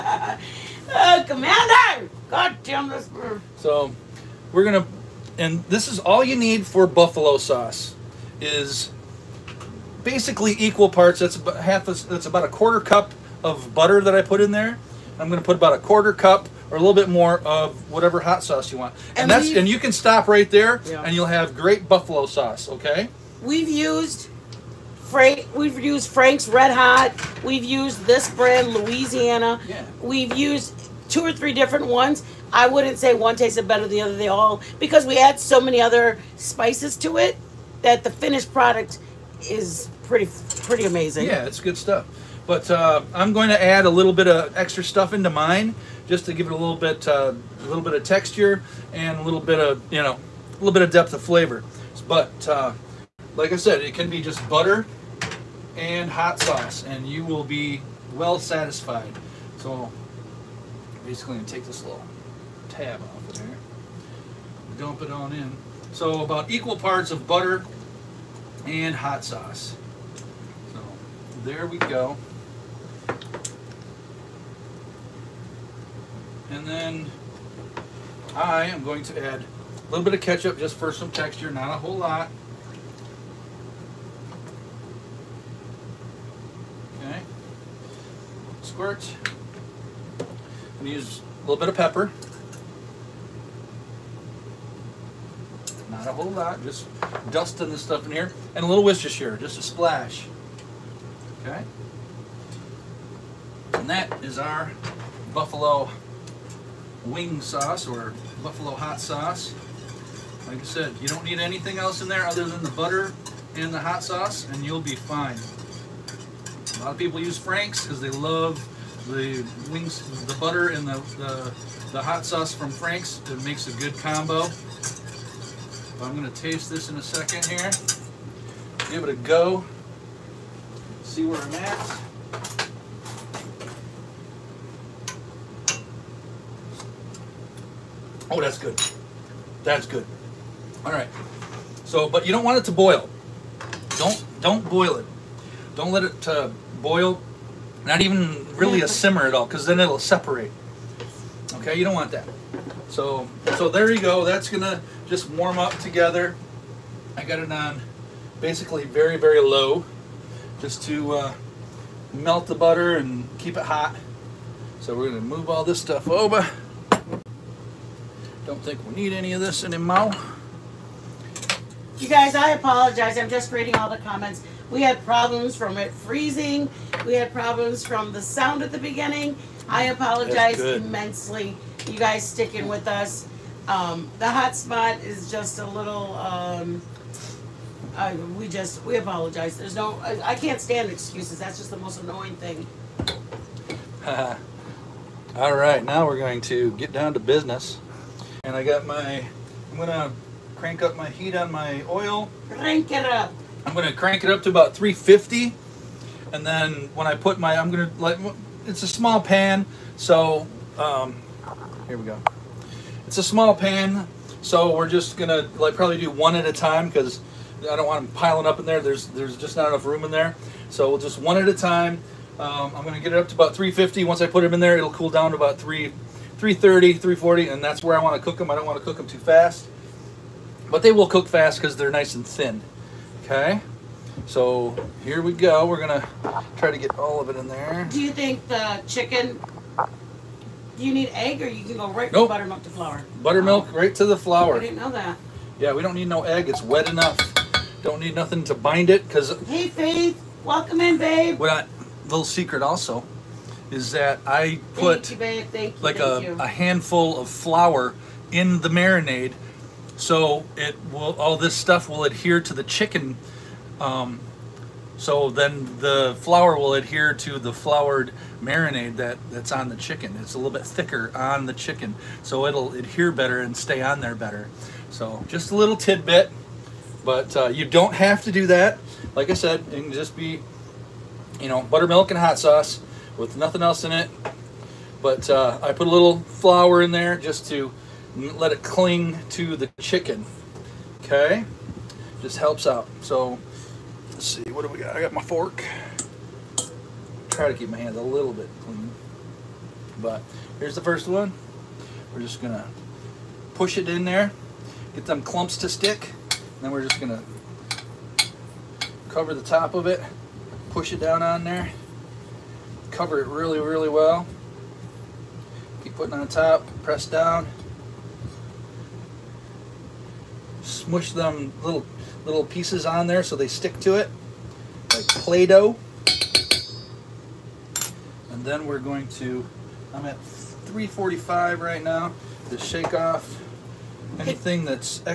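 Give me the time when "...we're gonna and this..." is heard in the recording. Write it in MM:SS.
00:04.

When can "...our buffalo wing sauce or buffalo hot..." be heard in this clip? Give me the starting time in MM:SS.
01:44.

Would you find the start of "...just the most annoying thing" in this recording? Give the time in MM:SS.
03:11.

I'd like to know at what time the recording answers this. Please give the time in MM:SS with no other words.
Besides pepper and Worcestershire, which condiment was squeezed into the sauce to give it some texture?
01:20.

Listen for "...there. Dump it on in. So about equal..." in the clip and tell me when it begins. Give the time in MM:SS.
01:03.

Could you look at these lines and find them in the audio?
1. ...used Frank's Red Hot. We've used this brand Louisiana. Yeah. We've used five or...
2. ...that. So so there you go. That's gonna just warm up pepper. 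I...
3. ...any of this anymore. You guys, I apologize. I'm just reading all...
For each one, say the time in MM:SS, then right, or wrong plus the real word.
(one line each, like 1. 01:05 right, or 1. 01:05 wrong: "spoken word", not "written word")
1. 00:25 wrong: "two", not "five"
2. 02:32 wrong: "together", not "pepper"
3. 02:49 right.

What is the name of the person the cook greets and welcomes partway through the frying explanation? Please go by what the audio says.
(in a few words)
Faith.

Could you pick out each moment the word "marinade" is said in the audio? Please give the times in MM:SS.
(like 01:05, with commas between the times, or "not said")
04:18, 04:28.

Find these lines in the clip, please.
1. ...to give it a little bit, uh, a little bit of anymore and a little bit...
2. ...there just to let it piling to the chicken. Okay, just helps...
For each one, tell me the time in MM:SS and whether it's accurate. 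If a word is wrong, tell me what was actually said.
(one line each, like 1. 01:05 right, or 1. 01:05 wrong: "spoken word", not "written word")
1. 00:46 wrong: "texture", not "anymore"
2. 04:46 wrong: "cling", not "piling".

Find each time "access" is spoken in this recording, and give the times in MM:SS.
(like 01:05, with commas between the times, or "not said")
not said.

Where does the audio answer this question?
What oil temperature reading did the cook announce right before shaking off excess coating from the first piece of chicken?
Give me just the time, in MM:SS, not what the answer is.
05:30.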